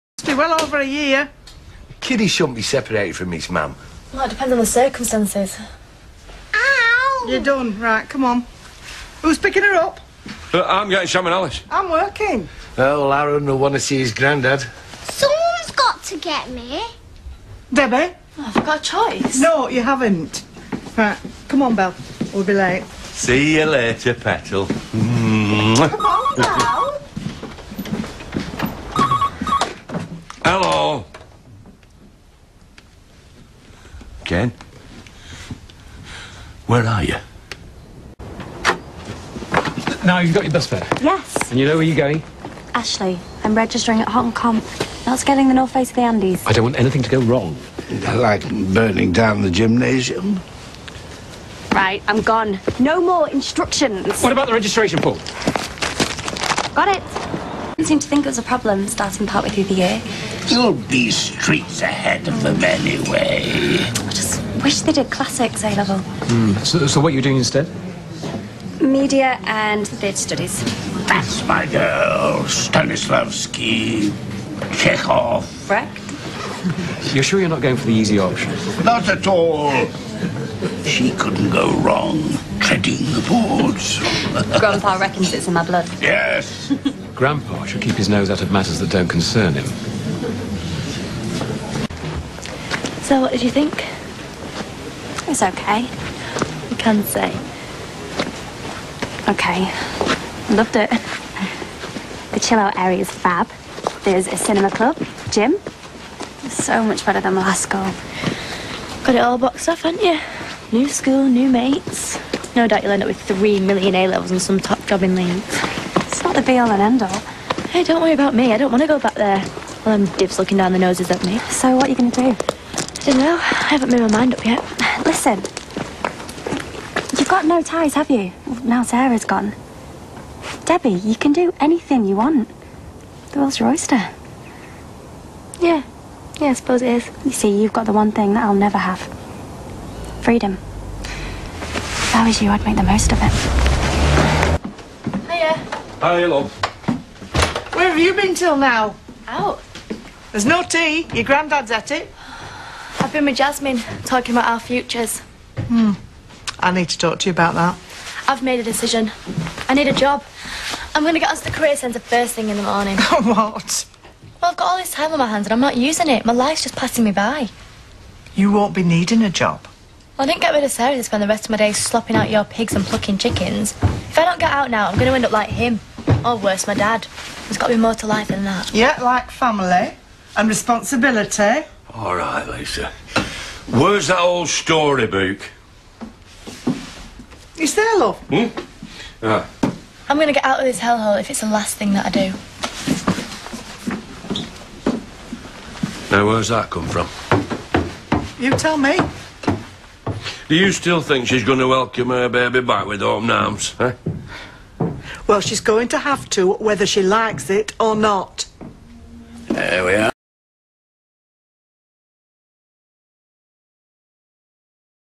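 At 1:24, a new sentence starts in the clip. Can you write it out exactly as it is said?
Grandpa reckons it's in my blood.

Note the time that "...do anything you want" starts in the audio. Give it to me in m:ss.
2:11.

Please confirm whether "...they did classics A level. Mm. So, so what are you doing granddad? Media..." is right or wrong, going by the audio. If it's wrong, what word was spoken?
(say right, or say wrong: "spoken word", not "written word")
wrong: "instead", not "granddad".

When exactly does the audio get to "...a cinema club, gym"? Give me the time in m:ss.
1:44.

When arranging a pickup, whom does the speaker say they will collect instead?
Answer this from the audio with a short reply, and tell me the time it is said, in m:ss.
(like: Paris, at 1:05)
Shannon Ellis, at 0:11.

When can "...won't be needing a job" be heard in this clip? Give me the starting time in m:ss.
2:48.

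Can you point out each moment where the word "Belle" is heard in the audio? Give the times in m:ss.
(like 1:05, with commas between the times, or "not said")
0:21, 0:26.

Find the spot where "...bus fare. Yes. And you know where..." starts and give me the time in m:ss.
0:40.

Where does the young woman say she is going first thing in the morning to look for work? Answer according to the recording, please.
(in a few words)
The career centre.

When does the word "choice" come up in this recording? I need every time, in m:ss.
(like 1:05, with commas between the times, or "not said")
0:18.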